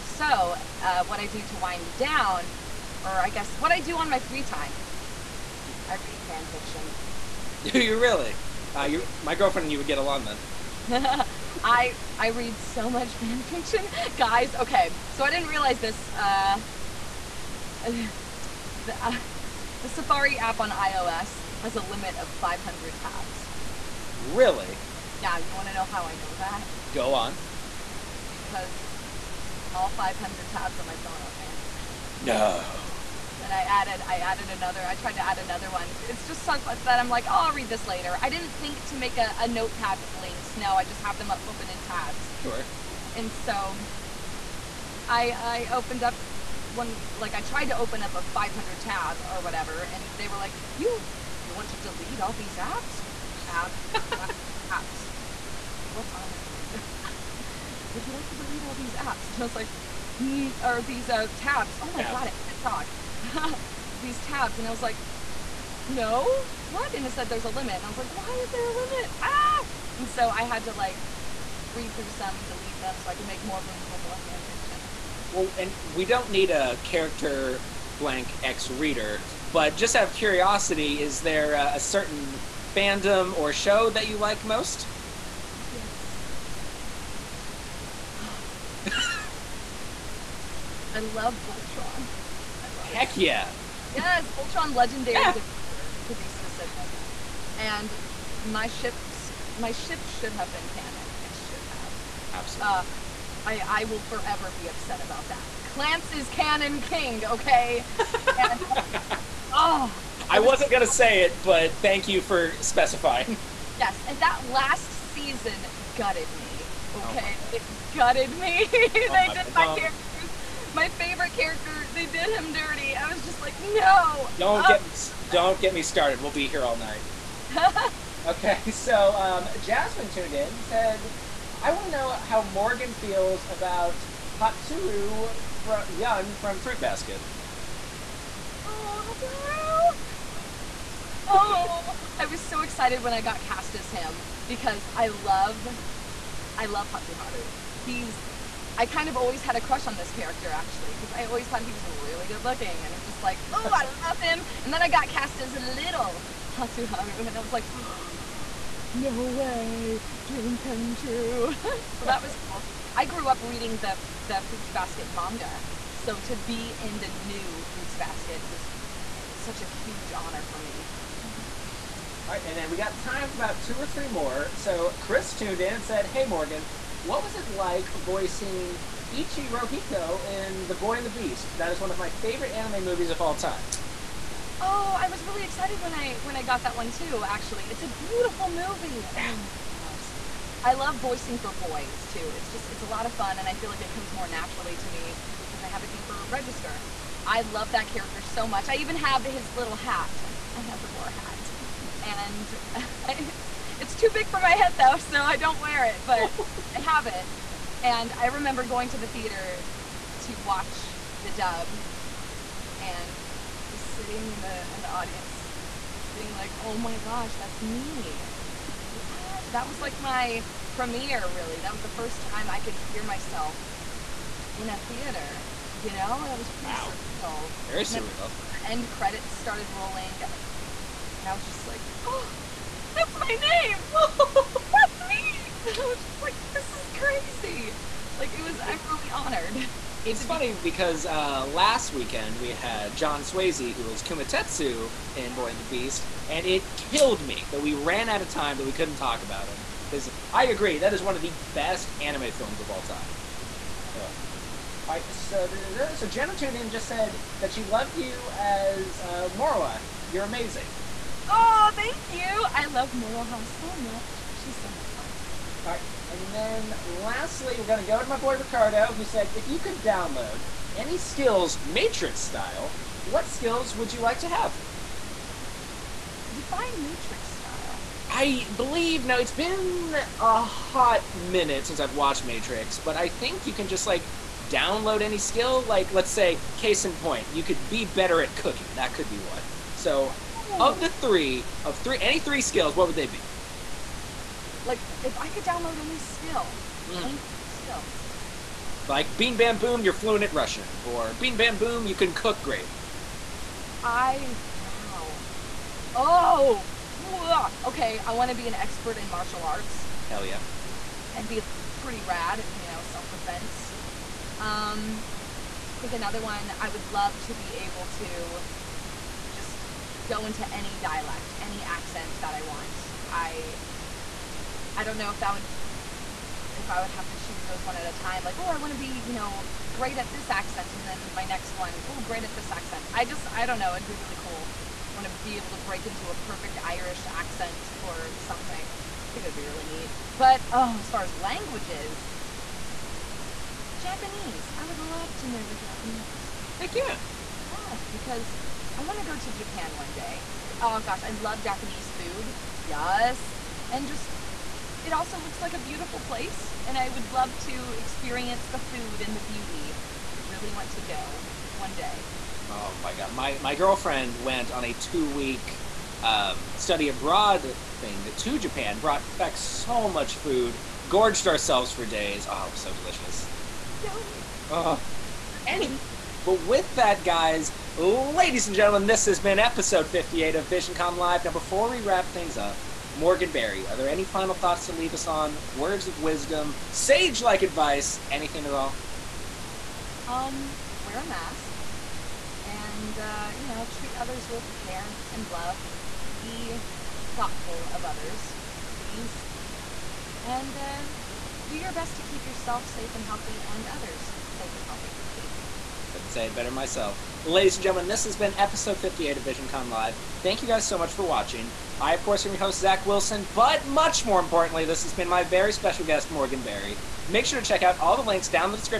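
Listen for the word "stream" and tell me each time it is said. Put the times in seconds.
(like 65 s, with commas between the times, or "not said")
not said.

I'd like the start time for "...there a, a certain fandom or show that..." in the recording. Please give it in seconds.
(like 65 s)
81 s.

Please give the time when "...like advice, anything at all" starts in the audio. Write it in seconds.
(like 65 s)
387 s.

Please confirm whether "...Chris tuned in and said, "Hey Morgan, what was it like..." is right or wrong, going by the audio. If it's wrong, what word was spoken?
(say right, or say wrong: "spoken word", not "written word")
right.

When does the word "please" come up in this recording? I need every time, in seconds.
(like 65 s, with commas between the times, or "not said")
398 s, 405 s.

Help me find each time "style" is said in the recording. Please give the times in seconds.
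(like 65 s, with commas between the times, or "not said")
272 s, 277 s.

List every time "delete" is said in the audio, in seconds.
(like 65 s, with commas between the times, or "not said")
51 s, 58 s, 72 s.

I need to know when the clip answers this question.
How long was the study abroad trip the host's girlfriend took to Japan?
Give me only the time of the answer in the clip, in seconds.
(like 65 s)
364 s.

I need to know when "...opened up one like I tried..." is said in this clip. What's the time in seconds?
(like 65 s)
45 s.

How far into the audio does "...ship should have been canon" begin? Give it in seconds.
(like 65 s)
99 s.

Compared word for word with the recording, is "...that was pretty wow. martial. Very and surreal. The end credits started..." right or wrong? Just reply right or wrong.
wrong.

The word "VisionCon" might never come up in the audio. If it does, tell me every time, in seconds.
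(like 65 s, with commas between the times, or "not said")
380 s, 409 s.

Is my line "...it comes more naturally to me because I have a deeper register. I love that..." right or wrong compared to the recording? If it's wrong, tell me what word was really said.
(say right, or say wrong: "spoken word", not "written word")
right.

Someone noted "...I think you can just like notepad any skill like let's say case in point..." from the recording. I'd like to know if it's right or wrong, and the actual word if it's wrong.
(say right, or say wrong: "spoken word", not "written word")
wrong: "download", not "notepad".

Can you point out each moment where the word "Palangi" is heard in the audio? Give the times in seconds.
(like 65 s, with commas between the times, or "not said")
not said.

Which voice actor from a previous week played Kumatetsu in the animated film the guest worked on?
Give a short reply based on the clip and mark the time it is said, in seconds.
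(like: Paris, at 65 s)
John Swasey, at 242 s.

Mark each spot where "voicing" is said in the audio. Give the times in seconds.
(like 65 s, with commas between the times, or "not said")
177 s, 190 s.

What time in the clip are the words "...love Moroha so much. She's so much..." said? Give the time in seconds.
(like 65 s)
262 s.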